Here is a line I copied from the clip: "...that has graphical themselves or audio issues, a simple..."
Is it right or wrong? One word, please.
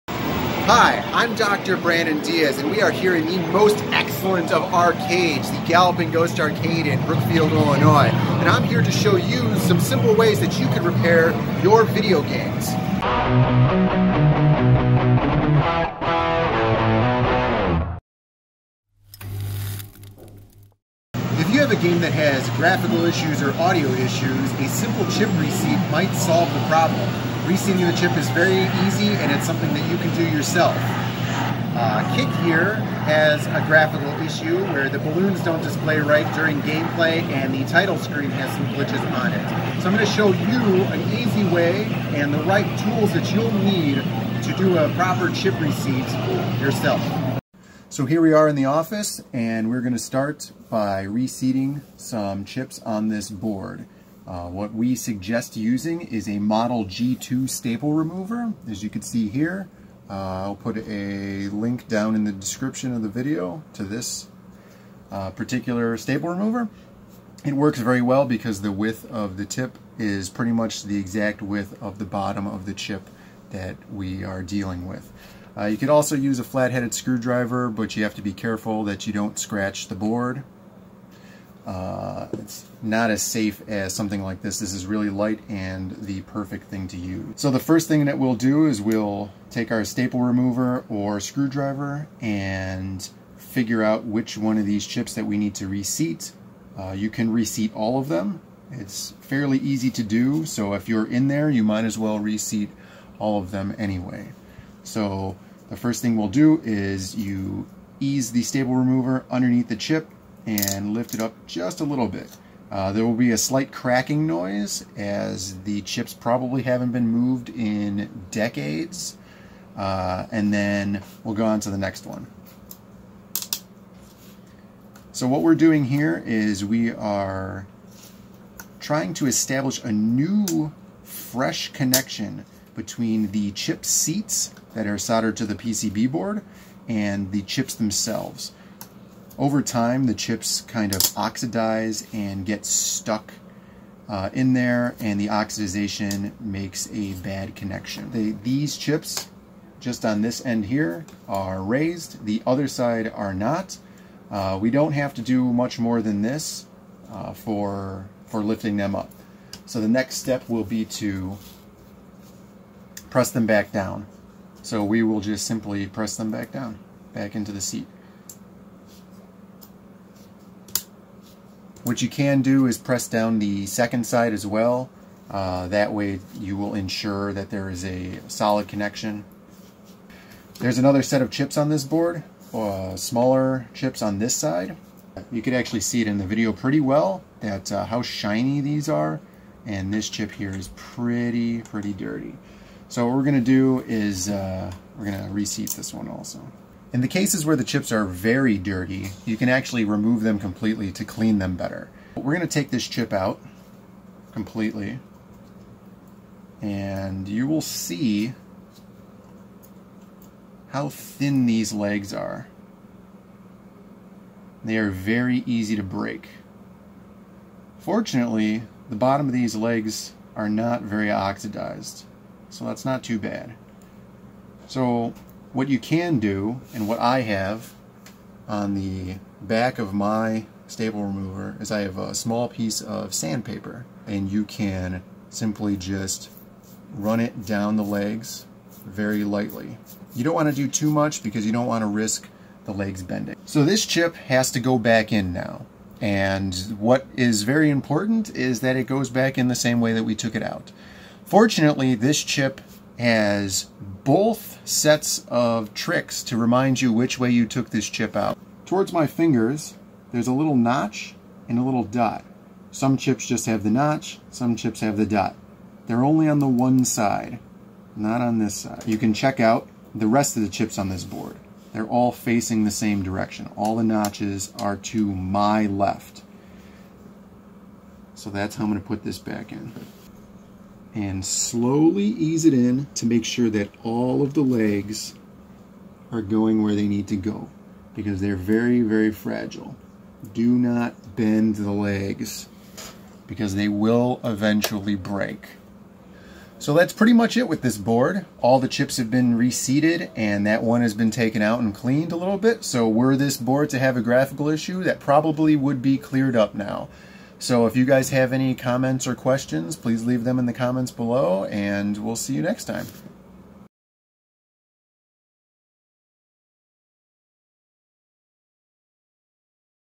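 wrong.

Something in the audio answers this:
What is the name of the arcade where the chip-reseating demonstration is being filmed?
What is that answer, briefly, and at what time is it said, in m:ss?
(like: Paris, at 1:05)
Galloping Ghost Arcade, at 0:05.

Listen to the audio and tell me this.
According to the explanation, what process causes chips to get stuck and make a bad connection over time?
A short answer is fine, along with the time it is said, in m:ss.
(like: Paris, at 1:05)
oxidization, at 2:25.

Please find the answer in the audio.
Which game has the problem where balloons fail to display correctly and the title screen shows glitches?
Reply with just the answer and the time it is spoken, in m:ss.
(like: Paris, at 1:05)
Kick, at 0:32.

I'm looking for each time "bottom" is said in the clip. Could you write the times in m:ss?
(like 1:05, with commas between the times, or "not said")
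1:12, 3:38.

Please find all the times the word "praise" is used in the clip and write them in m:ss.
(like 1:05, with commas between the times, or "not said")
not said.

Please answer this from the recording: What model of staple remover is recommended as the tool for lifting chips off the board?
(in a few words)
Model G2.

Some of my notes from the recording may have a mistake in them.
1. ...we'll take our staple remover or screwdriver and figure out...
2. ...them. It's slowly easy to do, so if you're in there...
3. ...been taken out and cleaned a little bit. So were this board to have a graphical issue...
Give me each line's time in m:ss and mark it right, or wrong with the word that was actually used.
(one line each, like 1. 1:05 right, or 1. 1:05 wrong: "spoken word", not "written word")
1. 1:28 right
2. 1:38 wrong: "fairly", not "slowly"
3. 5:00 right.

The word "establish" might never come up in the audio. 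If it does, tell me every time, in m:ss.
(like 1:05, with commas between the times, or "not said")
2:09.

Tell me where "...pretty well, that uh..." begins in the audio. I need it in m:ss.
3:06.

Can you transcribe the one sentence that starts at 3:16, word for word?
In the cases where the chips are very dirty, you can actually remove them completely to clean them better.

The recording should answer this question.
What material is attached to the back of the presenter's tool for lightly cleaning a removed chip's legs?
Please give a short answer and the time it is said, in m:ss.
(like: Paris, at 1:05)
sandpaper, at 3:53.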